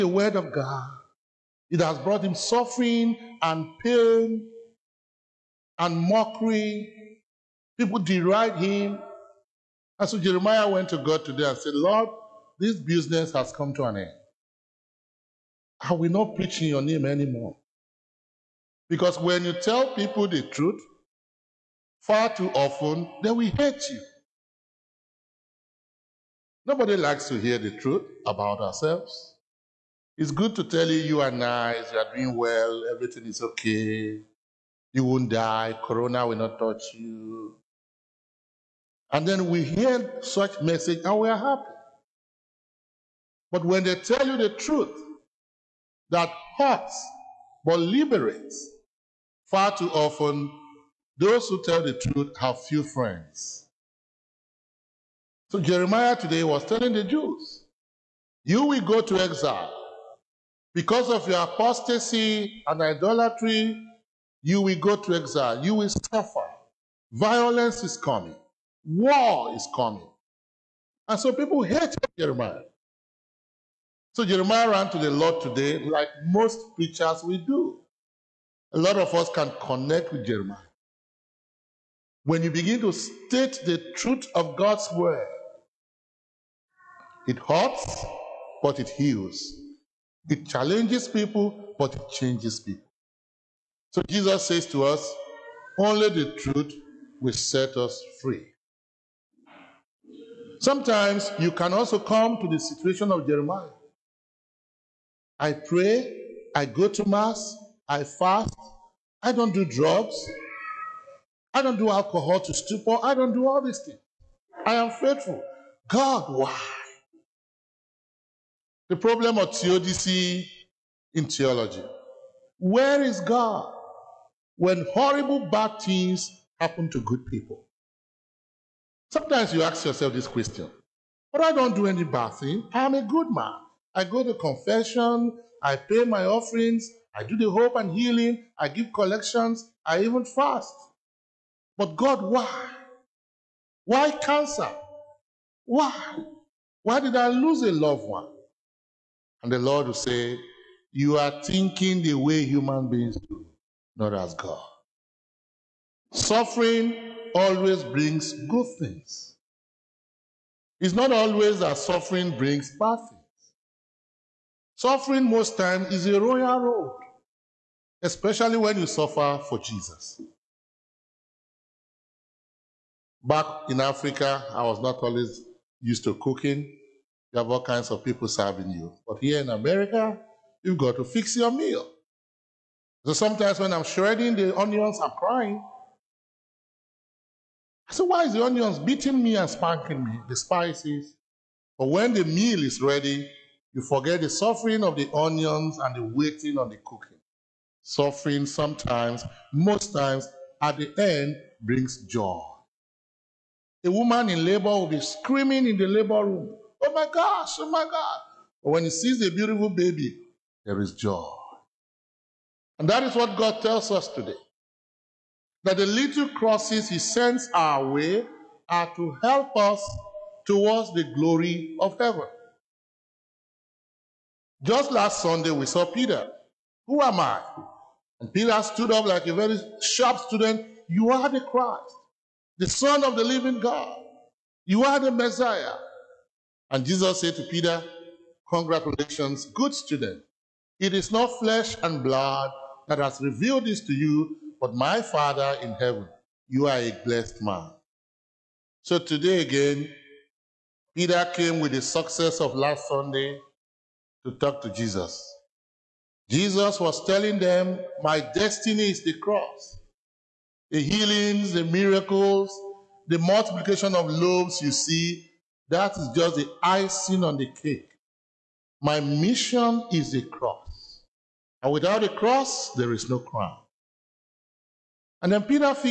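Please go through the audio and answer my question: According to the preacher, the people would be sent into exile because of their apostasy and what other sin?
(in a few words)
Idolatry.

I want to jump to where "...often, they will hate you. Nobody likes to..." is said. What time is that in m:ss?
0:22.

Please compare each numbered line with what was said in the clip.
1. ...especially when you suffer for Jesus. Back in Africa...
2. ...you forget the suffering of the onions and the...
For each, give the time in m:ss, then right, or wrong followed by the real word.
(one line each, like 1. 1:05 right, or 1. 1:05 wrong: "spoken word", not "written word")
1. 2:48 right
2. 3:13 right.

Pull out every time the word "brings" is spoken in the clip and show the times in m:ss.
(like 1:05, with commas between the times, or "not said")
2:37, 2:42, 3:21.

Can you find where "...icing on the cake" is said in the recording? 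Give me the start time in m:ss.
4:26.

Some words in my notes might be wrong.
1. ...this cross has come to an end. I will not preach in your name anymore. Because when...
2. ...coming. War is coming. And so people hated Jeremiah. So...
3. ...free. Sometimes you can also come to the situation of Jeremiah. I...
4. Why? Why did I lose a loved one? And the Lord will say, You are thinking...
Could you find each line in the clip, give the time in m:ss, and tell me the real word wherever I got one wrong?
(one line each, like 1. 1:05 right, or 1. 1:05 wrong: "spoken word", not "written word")
1. 0:12 wrong: "business", not "cross"
2. 1:07 right
3. 1:38 right
4. 2:25 right.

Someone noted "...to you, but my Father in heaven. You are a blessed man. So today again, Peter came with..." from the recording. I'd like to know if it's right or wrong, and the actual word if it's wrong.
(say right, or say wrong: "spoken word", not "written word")
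right.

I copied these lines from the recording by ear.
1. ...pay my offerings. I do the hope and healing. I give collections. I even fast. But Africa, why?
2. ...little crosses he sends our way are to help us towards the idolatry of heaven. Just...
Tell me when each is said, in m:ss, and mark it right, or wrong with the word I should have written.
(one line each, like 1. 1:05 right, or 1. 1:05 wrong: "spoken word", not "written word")
1. 2:15 wrong: "God", not "Africa"
2. 3:35 wrong: "glory", not "idolatry".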